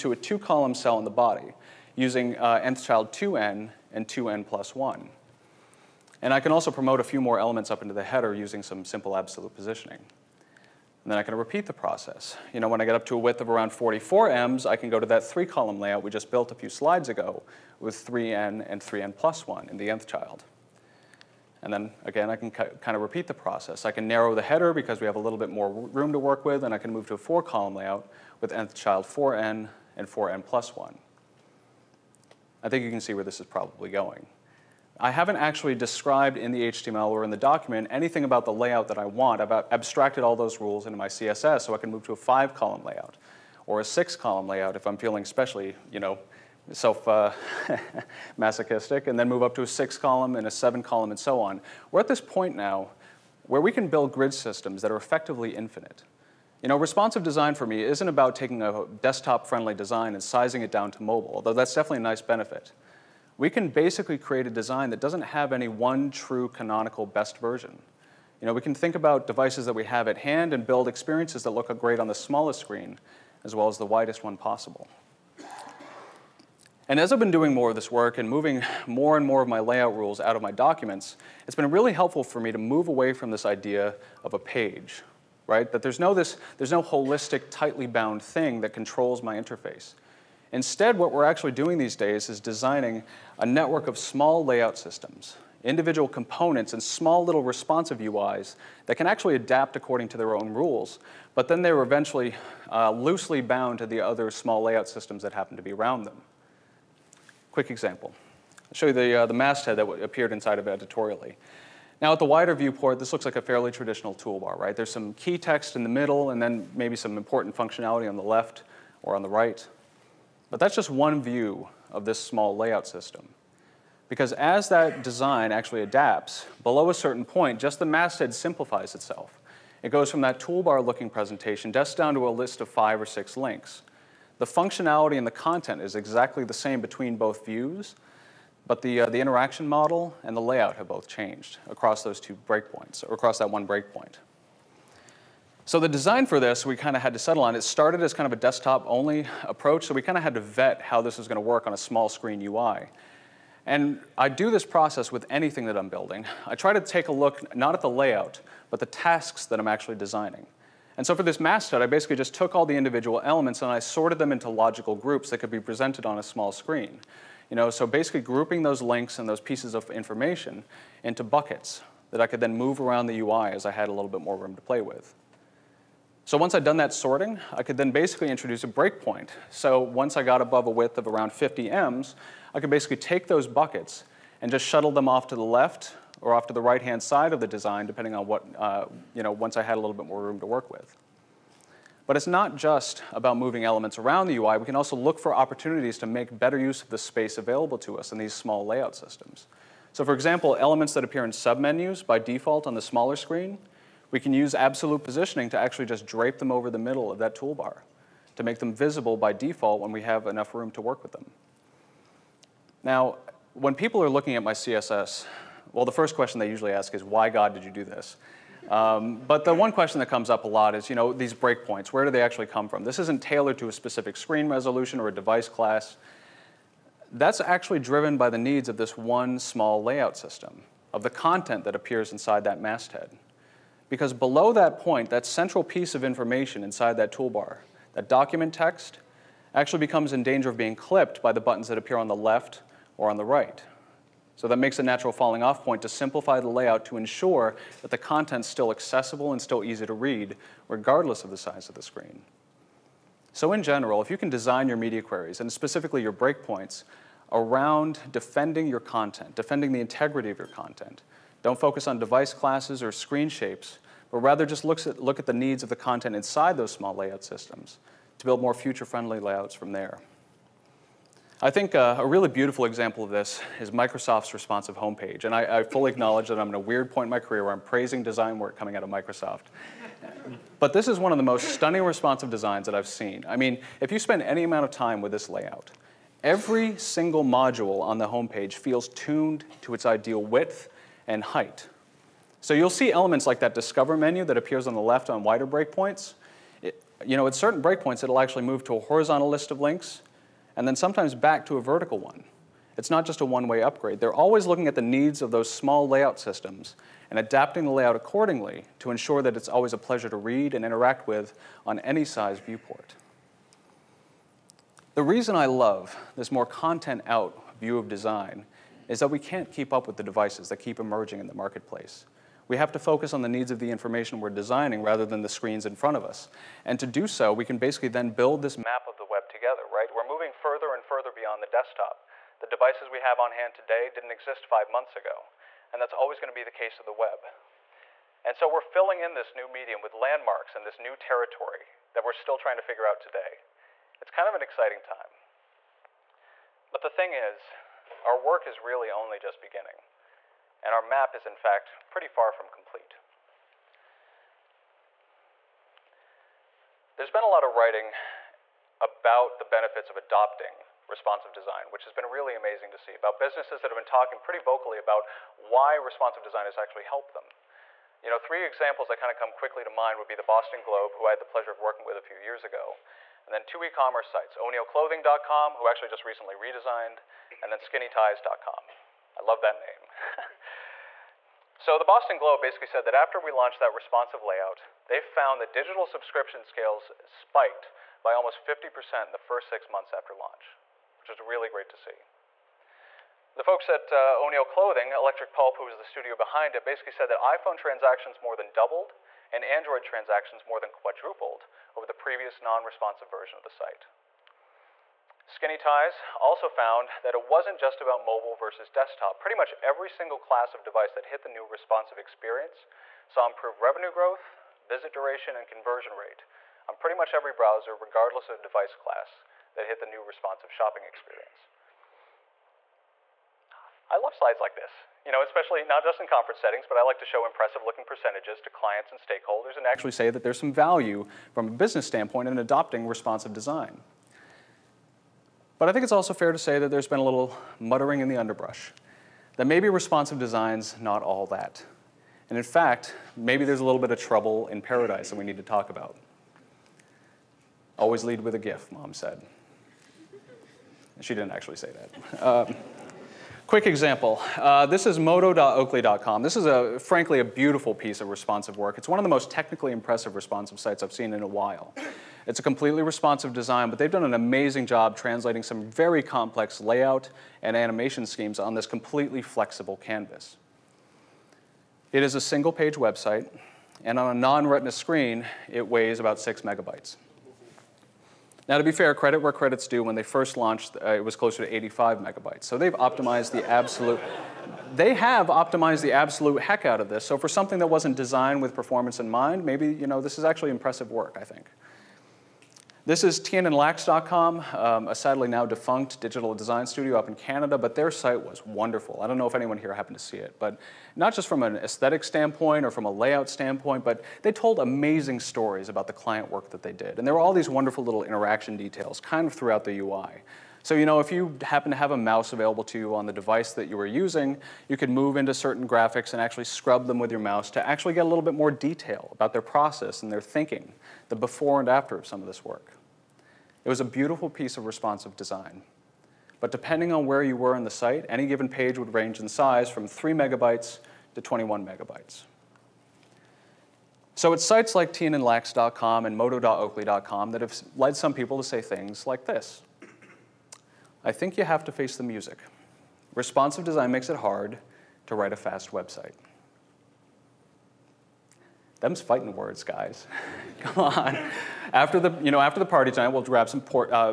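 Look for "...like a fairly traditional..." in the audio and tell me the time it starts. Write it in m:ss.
1:53.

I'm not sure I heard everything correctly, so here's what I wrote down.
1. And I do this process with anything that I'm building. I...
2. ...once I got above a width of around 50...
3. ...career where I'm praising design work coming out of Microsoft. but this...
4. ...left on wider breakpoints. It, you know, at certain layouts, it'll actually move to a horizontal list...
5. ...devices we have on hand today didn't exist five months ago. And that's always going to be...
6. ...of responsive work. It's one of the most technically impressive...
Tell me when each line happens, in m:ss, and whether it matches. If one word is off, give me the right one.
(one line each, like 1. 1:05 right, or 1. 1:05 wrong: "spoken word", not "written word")
1. 2:33 right
2. 2:59 right
3. 4:37 right
4. 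4:54 wrong: "breakpoints", not "layouts"
5. 5:32 right
6. 7:38 right.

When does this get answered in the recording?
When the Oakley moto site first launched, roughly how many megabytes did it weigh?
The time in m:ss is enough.
8:01.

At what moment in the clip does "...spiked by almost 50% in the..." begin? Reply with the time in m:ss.
6:27.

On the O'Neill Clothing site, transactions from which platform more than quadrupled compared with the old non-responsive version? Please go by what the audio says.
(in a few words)
Android.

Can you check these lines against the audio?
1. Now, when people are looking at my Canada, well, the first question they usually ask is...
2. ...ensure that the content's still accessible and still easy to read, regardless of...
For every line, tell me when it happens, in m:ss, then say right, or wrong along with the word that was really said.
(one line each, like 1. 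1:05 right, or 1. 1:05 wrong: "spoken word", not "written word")
1. 3:32 wrong: "CSS", not "Canada"
2. 4:06 right.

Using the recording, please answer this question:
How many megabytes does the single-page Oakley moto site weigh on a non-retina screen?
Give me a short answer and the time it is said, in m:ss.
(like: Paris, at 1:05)
6 megabytes, at 7:56.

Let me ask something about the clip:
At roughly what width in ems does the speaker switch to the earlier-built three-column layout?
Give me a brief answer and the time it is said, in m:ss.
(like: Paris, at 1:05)
44 ems, at 0:13.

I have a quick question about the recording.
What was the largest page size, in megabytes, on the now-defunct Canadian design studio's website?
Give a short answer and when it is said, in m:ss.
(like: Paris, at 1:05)
21 megabytes, at 8:51.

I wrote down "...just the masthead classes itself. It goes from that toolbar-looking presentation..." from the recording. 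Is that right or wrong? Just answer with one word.
wrong.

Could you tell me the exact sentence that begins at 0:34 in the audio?
I haven't actually described in the HTML or in the document anything about the layout that I want.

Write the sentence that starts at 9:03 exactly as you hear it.
Responsive design makes it hard to write a fast website.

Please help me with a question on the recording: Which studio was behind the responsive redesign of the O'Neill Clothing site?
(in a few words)
Electric Pulp.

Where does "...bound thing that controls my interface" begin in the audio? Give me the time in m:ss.
1:27.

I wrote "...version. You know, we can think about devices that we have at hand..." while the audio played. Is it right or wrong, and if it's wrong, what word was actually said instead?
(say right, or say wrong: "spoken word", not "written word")
right.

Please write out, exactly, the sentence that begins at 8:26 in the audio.
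And there were all these wonderful little interaction details kind of throughout the UI.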